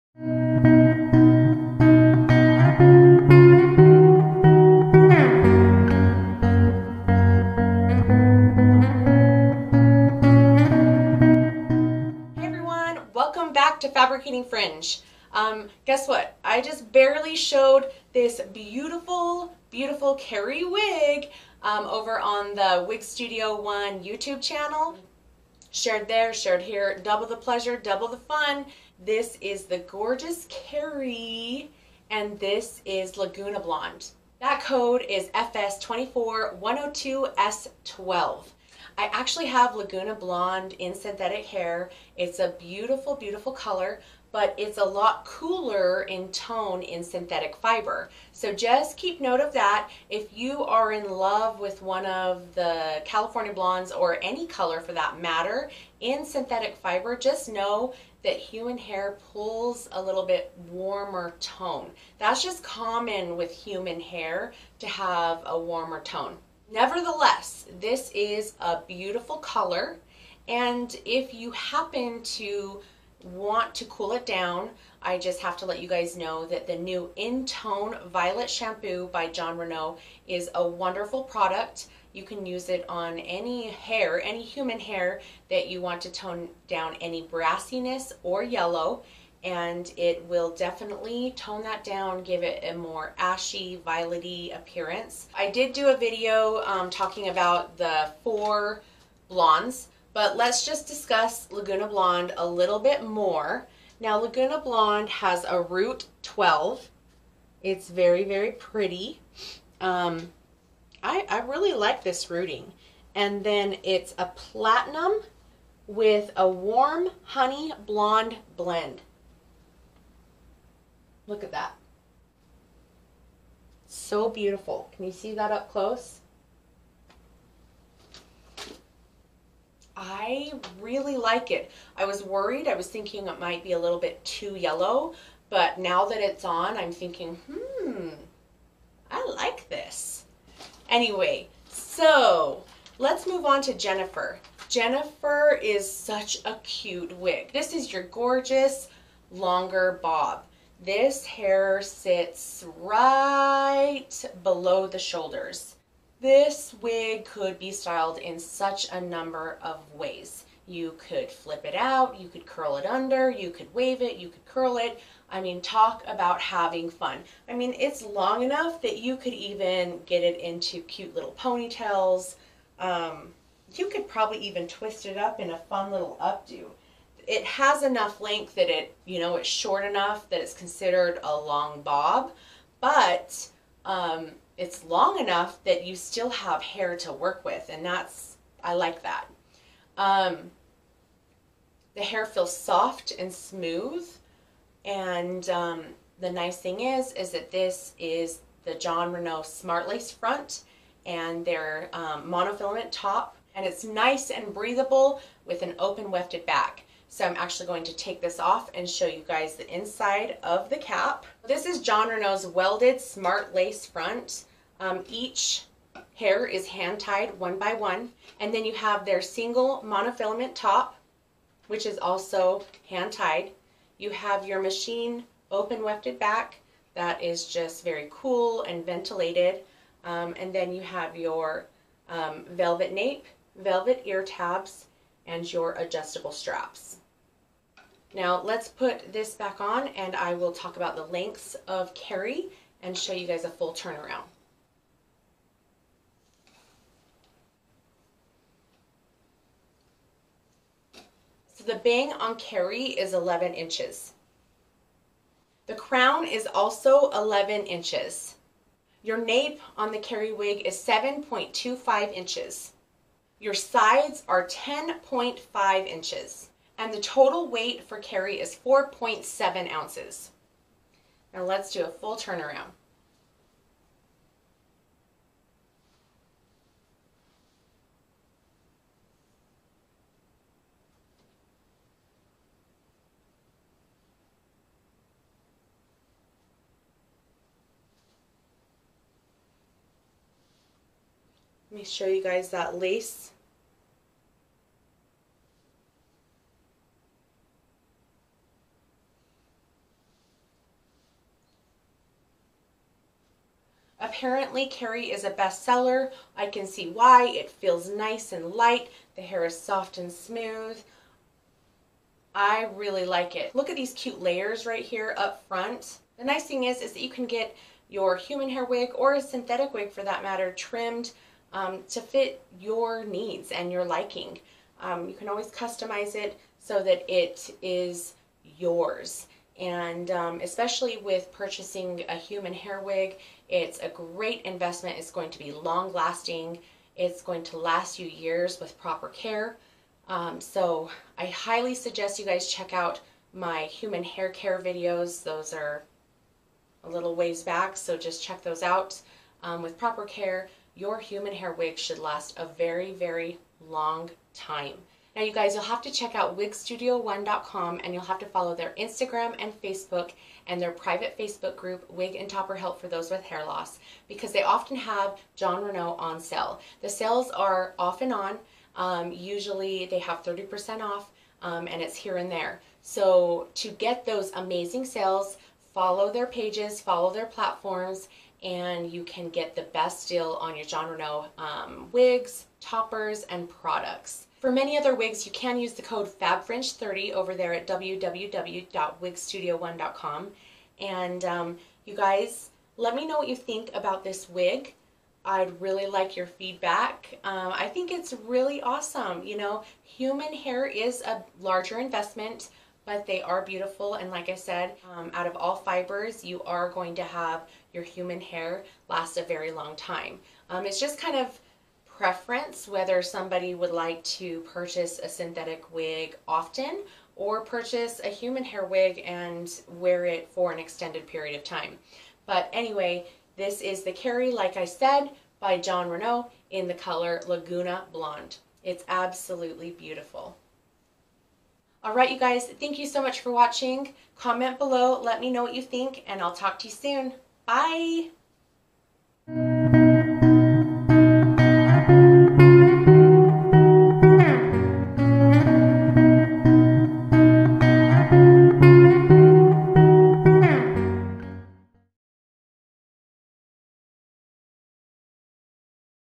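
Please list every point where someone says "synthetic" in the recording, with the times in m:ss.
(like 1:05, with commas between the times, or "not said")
0:40, 0:47, 0:56, 5:19, 6:55.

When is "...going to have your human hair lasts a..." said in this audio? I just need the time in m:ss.
6:46.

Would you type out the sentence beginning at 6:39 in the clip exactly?
You know, human hair is a larger investment, but they are beautiful.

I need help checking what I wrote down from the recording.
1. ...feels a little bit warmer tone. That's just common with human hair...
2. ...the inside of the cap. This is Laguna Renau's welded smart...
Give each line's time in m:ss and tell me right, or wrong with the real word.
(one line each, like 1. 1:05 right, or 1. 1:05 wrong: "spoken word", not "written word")
1. 0:59 wrong: "pulls", not "feels"
2. 3:29 wrong: "Jon", not "Laguna".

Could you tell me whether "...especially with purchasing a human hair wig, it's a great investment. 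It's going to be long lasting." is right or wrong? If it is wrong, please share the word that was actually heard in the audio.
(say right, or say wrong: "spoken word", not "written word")
right.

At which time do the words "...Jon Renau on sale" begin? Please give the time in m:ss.
6:05.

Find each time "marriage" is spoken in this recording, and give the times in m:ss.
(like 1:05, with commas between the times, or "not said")
not said.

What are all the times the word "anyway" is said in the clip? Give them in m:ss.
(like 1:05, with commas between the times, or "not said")
2:20, 7:02.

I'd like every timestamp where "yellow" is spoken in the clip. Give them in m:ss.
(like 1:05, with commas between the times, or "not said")
1:28, 2:14.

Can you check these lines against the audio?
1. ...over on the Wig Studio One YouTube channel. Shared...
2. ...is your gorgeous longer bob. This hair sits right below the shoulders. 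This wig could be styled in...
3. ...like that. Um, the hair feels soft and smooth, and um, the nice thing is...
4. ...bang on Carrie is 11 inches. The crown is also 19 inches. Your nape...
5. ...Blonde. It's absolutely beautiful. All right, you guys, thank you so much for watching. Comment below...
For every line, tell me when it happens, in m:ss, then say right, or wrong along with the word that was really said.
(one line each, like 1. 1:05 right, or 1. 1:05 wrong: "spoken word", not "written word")
1. 0:21 right
2. 2:27 right
3. 3:08 right
4. 4:11 wrong: "11", not "19"
5. 7:07 right.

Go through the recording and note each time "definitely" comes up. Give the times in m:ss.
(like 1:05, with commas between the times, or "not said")
1:30.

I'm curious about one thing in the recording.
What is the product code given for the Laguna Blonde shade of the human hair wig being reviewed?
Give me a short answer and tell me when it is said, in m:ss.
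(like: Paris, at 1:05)
FS24102S12, at 0:35.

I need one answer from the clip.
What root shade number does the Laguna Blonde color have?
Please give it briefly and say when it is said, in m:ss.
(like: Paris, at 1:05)
12, at 1:45.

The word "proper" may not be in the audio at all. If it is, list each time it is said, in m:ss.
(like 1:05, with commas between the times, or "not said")
5:38, 5:49.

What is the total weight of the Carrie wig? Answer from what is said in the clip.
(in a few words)
4.7 ounces.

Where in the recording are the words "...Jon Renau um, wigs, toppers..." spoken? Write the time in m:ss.
6:20.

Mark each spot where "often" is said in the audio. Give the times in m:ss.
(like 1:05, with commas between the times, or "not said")
6:04, 6:56.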